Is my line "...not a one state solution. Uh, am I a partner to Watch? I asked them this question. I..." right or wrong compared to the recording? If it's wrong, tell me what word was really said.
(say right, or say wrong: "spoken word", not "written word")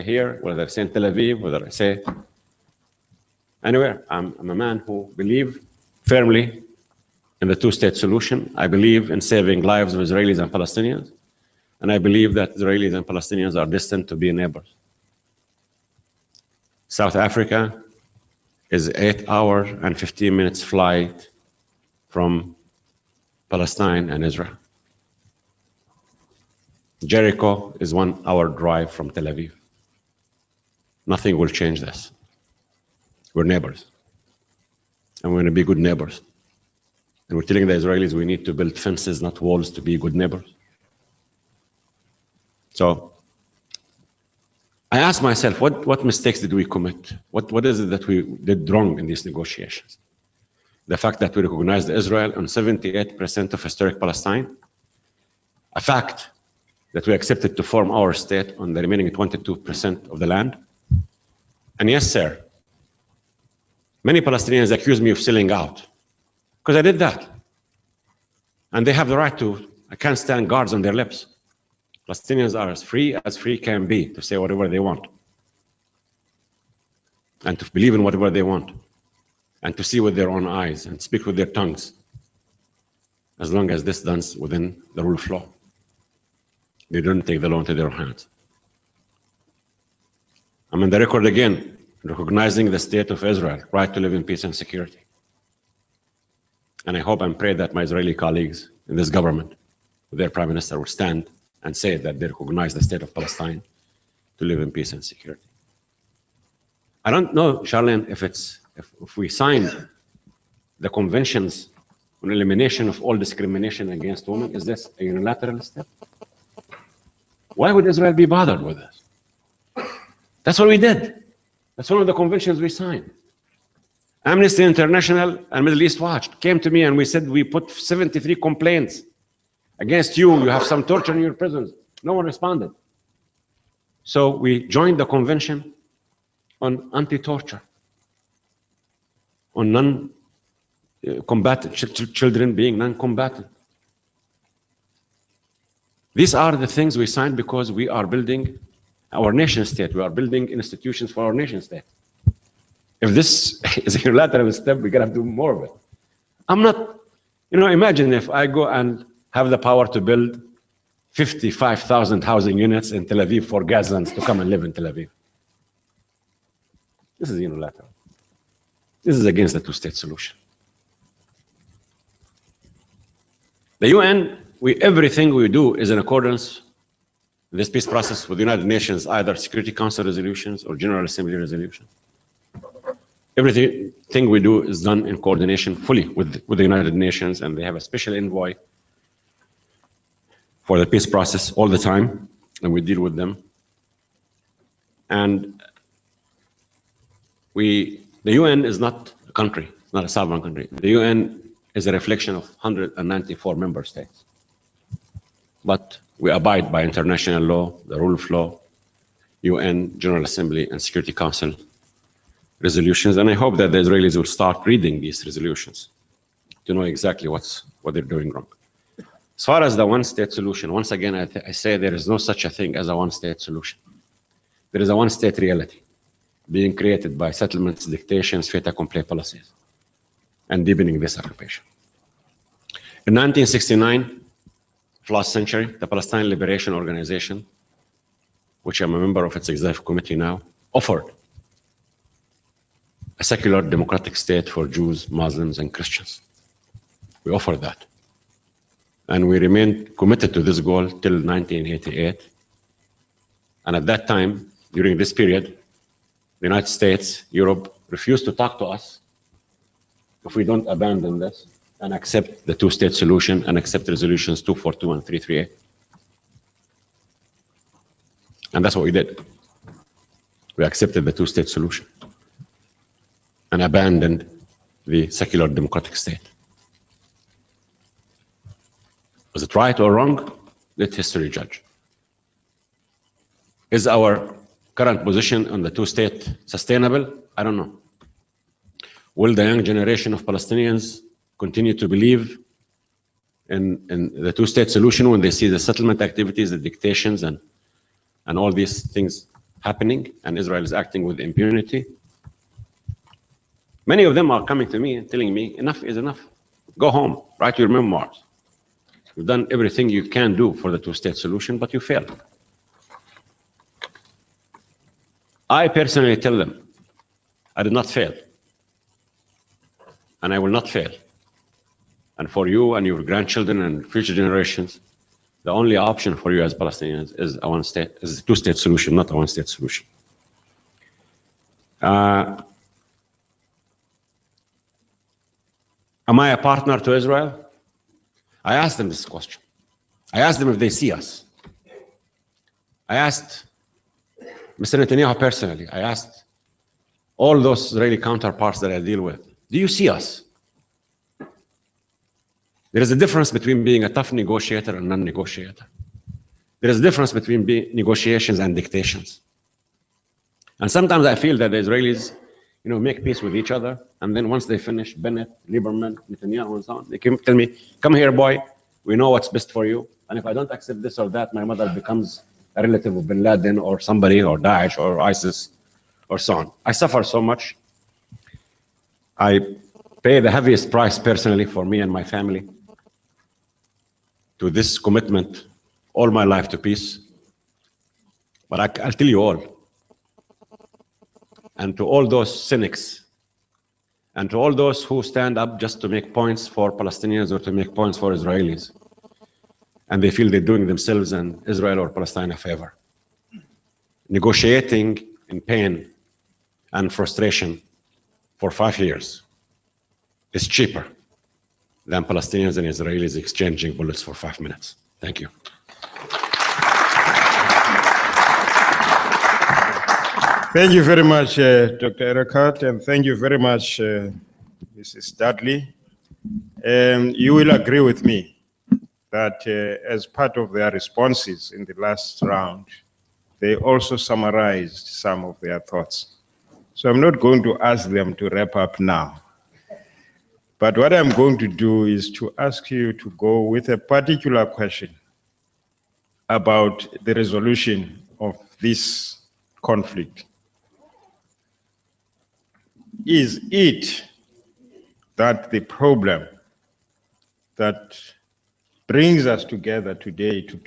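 wrong: "Israel", not "Watch".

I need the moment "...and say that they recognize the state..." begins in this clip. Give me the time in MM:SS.
01:41.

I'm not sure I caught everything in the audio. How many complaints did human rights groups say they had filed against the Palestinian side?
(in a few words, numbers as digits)
73.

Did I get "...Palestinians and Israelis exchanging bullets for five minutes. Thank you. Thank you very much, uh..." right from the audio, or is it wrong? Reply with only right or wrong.
right.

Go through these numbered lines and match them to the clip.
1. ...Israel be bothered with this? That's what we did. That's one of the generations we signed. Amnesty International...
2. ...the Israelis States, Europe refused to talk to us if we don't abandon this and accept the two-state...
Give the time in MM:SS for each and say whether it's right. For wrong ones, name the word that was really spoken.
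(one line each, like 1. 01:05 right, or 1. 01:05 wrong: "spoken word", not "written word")
1. 01:57 wrong: "conventions", not "generations"
2. 04:16 wrong: "United", not "Israelis".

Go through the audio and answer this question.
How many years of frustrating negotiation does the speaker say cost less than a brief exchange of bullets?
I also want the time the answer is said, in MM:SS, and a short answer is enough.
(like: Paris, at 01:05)
5, at 06:48.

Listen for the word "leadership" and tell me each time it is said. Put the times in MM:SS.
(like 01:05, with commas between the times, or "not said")
not said.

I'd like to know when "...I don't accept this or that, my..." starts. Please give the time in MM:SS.
06:10.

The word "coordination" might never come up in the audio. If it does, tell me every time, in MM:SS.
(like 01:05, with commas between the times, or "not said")
03:05.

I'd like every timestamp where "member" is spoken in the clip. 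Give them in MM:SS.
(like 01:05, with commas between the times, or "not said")
03:23, 03:58.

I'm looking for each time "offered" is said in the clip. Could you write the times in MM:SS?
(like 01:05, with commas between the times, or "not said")
04:00, 04:07.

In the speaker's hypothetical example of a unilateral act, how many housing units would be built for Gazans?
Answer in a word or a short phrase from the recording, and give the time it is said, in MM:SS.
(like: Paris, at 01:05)
55,000, at 02:41.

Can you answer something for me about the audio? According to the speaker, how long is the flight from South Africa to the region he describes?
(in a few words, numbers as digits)
8 hours 15 minutes.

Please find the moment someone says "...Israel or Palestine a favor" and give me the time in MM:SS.
06:41.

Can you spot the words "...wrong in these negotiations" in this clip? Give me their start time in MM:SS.
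00:48.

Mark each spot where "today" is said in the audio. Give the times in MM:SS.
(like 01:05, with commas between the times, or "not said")
07:39.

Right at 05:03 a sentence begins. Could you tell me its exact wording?
Many of them are coming to me and telling me, enough is enough.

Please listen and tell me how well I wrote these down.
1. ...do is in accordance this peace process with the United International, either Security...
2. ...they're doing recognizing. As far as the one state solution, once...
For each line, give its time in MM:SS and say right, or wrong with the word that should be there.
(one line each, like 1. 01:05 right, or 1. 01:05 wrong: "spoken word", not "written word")
1. 02:55 wrong: "Nations", not "International"
2. 03:37 wrong: "wrong", not "recognizing".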